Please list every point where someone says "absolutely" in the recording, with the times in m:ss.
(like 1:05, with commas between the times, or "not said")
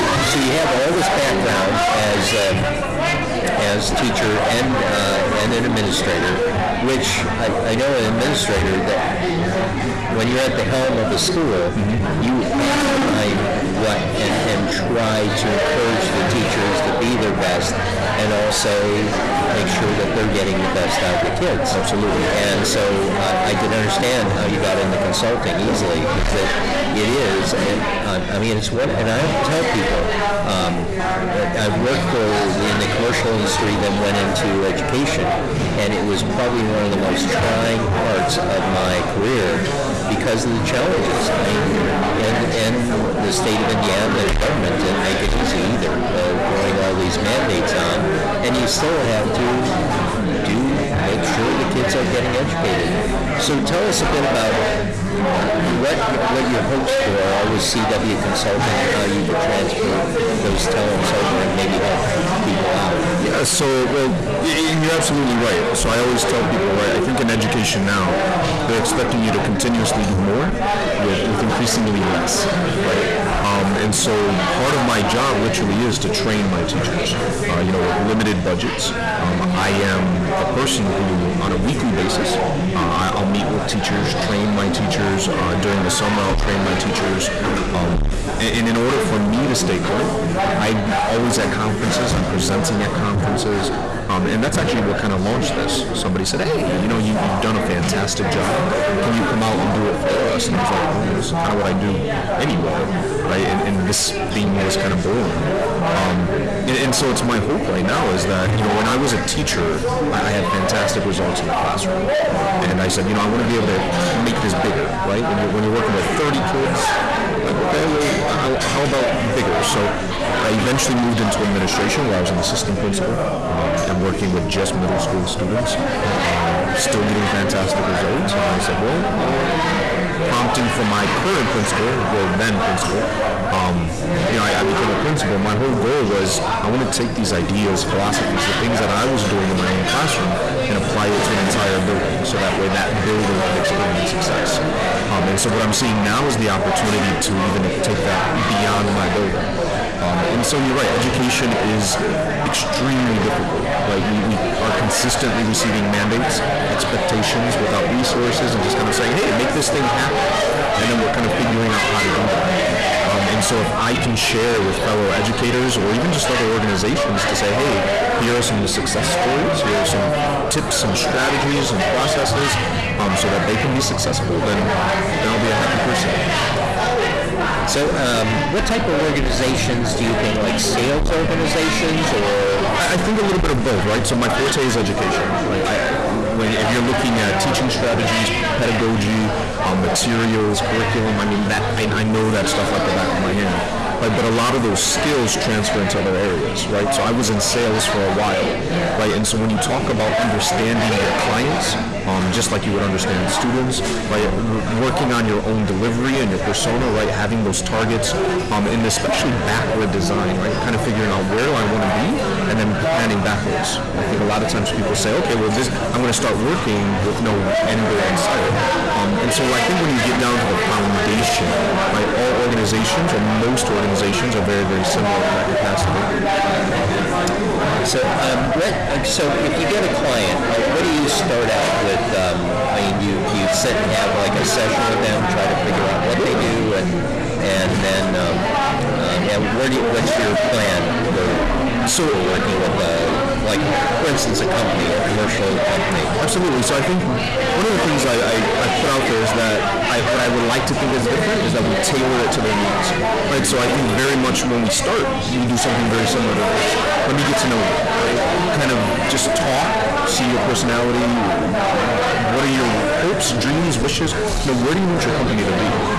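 0:21, 1:04, 4:06.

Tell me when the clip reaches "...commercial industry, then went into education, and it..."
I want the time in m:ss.
0:32.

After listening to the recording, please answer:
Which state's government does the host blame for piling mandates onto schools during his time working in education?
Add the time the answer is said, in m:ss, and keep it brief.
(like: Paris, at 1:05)
Indiana, at 0:43.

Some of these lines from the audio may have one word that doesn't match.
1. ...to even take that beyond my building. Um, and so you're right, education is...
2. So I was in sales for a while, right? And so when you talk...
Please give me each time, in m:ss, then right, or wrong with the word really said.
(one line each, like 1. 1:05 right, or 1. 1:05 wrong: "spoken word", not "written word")
1. 2:27 right
2. 3:16 right.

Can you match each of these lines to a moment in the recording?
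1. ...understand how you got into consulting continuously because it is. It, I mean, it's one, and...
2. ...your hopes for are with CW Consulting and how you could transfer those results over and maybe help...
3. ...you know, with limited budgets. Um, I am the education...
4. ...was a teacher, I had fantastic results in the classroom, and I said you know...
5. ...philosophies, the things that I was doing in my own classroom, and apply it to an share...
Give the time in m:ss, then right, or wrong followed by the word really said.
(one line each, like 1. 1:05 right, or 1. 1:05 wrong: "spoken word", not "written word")
1. 0:23 wrong: "easily", not "continuously"
2. 0:56 wrong: "talents", not "results"
3. 1:17 wrong: "person", not "education"
4. 1:48 right
5. 2:17 wrong: "entire", not "share".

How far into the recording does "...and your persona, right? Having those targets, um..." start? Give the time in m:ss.
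3:26.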